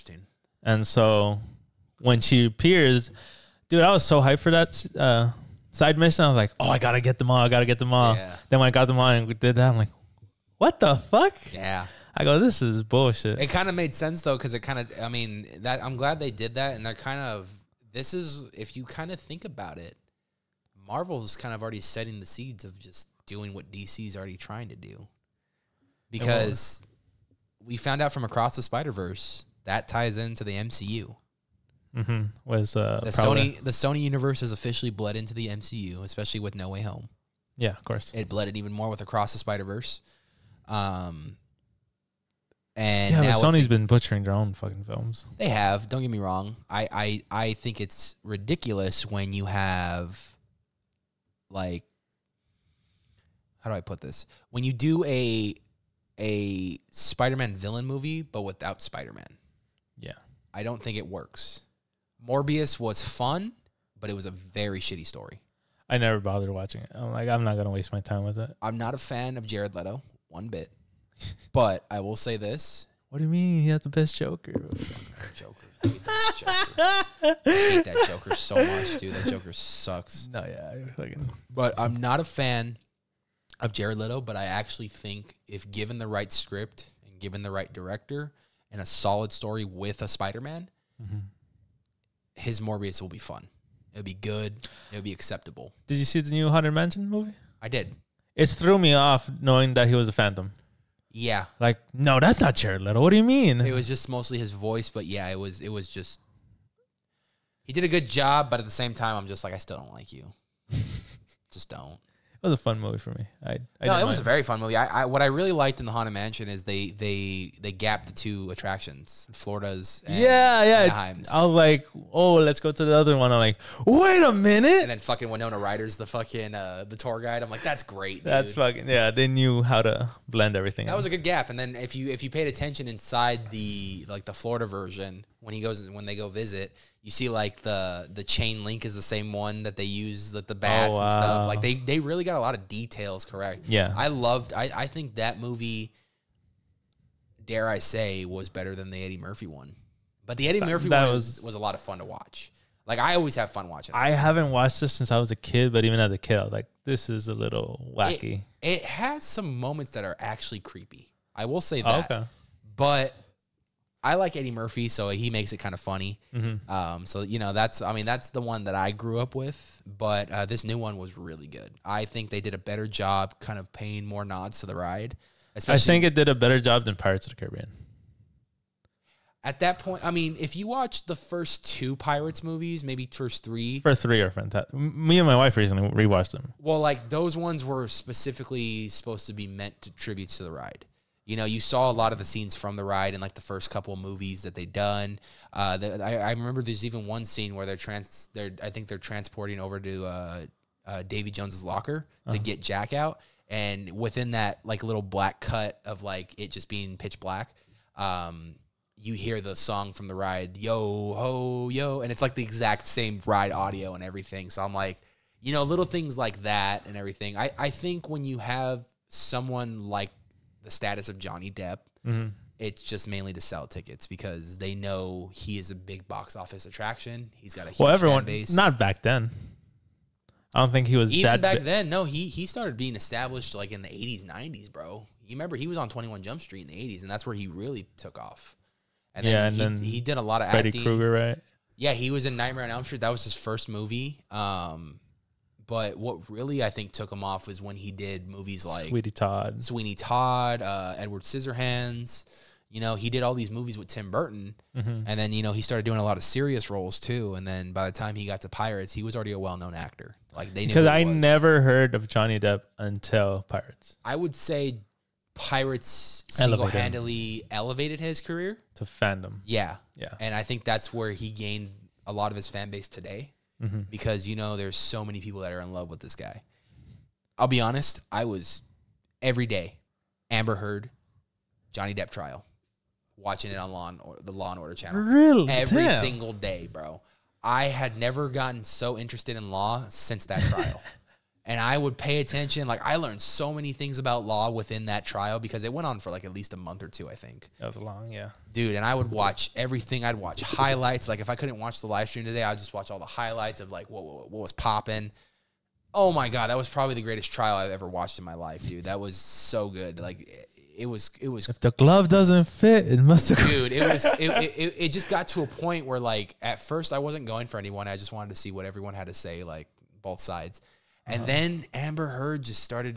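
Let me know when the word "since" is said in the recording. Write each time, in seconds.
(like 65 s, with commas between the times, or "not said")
154 s, 289 s.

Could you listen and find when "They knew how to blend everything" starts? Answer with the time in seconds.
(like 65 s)
129 s.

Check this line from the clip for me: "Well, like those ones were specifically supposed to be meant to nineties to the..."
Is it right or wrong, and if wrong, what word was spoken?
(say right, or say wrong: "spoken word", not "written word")
wrong: "tributes", not "nineties".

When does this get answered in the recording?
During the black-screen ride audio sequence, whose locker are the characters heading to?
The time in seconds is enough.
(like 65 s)
201 s.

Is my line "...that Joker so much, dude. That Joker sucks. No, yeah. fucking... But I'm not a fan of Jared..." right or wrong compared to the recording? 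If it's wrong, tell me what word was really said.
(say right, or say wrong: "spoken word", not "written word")
right.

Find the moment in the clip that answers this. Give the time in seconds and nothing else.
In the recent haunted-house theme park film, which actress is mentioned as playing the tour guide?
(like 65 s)
125 s.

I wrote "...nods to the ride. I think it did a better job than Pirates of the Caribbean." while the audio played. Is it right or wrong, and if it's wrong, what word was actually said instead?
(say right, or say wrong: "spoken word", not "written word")
right.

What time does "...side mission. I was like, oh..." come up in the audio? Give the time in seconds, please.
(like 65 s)
5 s.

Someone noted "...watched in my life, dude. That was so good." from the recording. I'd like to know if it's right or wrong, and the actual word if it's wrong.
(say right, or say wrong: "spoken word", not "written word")
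right.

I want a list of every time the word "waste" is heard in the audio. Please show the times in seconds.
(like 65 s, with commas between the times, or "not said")
67 s.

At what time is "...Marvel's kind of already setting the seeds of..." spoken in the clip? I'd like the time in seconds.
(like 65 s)
20 s.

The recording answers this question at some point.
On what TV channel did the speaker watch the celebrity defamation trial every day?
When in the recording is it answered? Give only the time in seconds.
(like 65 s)
284 s.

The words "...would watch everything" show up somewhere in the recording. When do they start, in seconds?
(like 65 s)
298 s.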